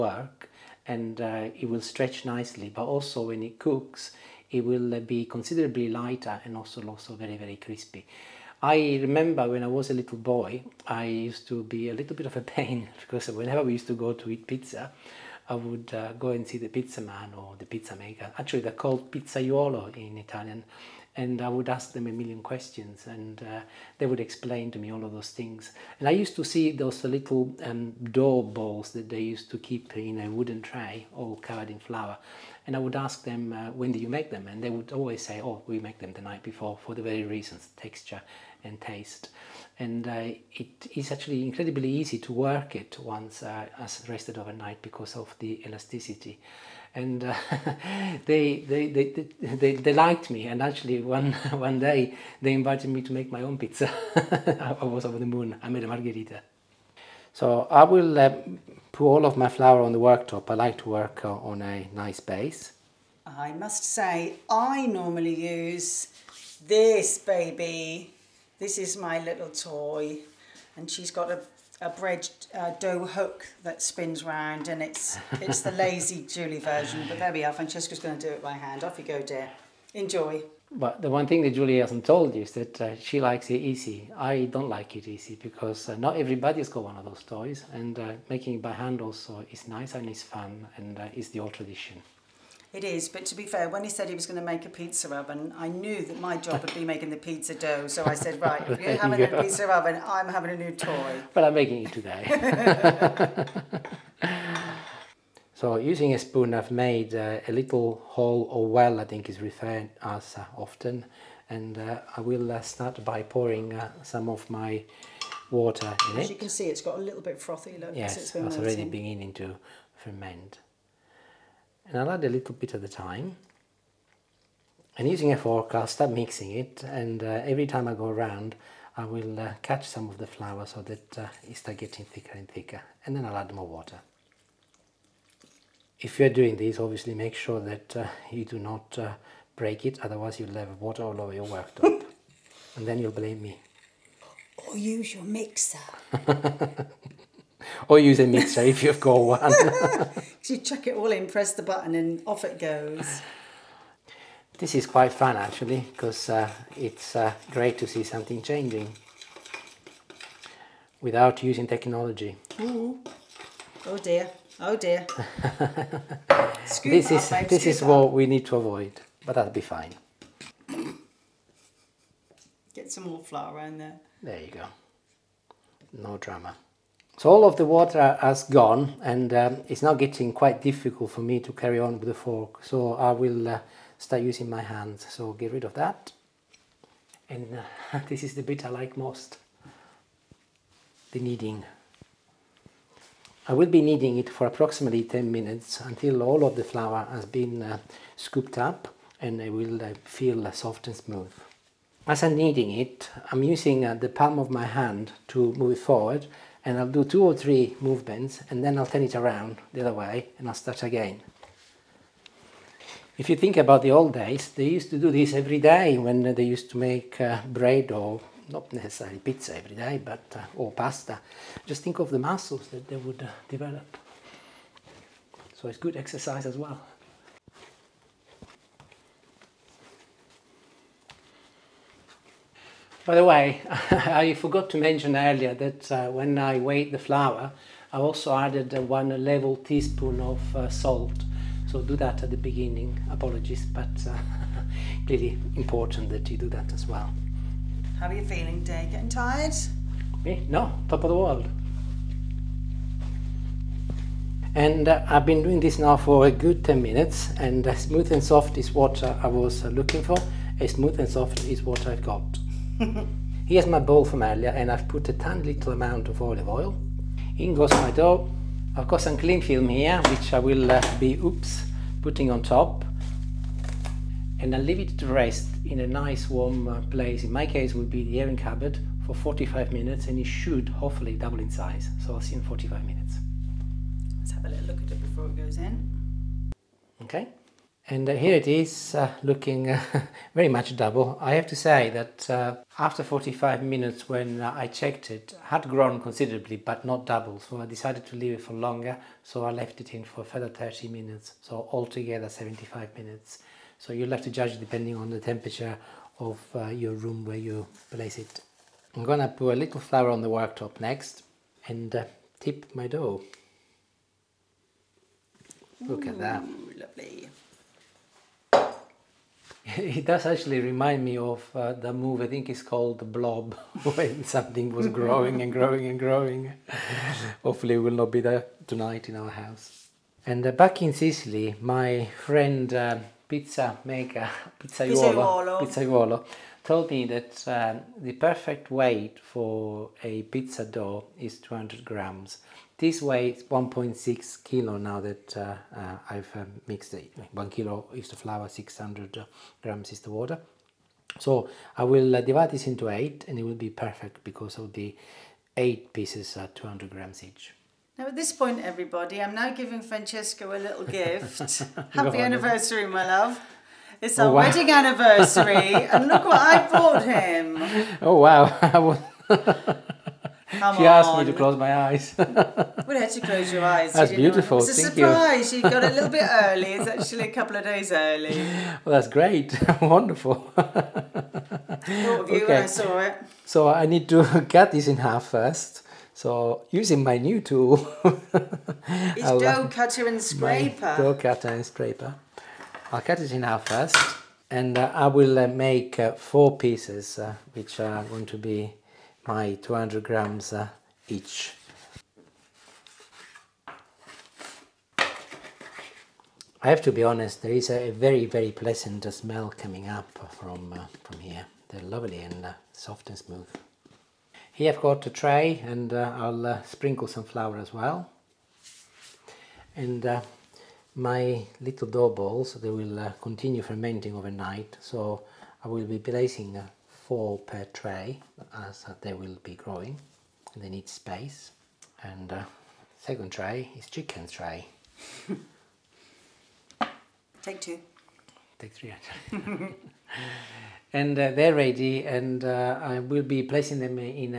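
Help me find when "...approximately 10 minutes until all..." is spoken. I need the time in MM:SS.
03:14.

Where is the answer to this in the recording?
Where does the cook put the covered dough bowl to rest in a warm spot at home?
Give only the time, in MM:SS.
04:38.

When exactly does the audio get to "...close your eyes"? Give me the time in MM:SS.
06:13.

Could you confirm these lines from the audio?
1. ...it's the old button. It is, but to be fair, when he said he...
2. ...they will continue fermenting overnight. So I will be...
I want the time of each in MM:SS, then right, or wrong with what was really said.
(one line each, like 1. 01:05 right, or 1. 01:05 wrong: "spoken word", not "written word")
1. 01:31 wrong: "tradition", not "button"
2. 07:02 right.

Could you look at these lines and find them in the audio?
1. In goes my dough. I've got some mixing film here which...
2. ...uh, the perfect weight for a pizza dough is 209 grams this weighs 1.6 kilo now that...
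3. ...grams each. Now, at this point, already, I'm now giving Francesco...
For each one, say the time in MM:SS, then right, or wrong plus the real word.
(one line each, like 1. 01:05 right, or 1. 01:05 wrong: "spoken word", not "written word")
1. 04:27 wrong: "cling", not "mixing"
2. 05:37 wrong: "200", not "209"
3. 05:56 wrong: "everybody", not "already".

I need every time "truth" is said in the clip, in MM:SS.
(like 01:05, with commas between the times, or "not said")
not said.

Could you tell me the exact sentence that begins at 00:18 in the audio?
Actually, they're called pizzaiolo in Italian.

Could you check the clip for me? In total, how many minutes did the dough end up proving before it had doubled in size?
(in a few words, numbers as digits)
75 minutes.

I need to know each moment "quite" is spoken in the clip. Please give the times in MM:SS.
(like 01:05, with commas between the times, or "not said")
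02:34, 03:00.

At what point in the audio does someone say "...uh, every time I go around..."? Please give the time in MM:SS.
02:07.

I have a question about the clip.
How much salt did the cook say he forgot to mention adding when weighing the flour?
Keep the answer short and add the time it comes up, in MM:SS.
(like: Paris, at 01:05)
1 level teaspoon, at 03:58.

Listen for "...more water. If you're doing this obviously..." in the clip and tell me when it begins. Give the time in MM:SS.
02:13.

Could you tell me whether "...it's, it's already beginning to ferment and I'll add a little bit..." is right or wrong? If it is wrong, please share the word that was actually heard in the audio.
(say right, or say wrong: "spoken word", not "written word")
right.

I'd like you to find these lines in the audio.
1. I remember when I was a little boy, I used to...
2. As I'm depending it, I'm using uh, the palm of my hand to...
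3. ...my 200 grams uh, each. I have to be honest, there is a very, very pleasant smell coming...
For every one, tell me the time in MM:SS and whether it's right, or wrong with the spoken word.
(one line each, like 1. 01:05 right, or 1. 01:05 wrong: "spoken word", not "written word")
1. 00:08 right
2. 03:22 wrong: "kneading", not "depending"
3. 06:39 right.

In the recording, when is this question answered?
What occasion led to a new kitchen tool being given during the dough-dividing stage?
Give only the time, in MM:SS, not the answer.
06:04.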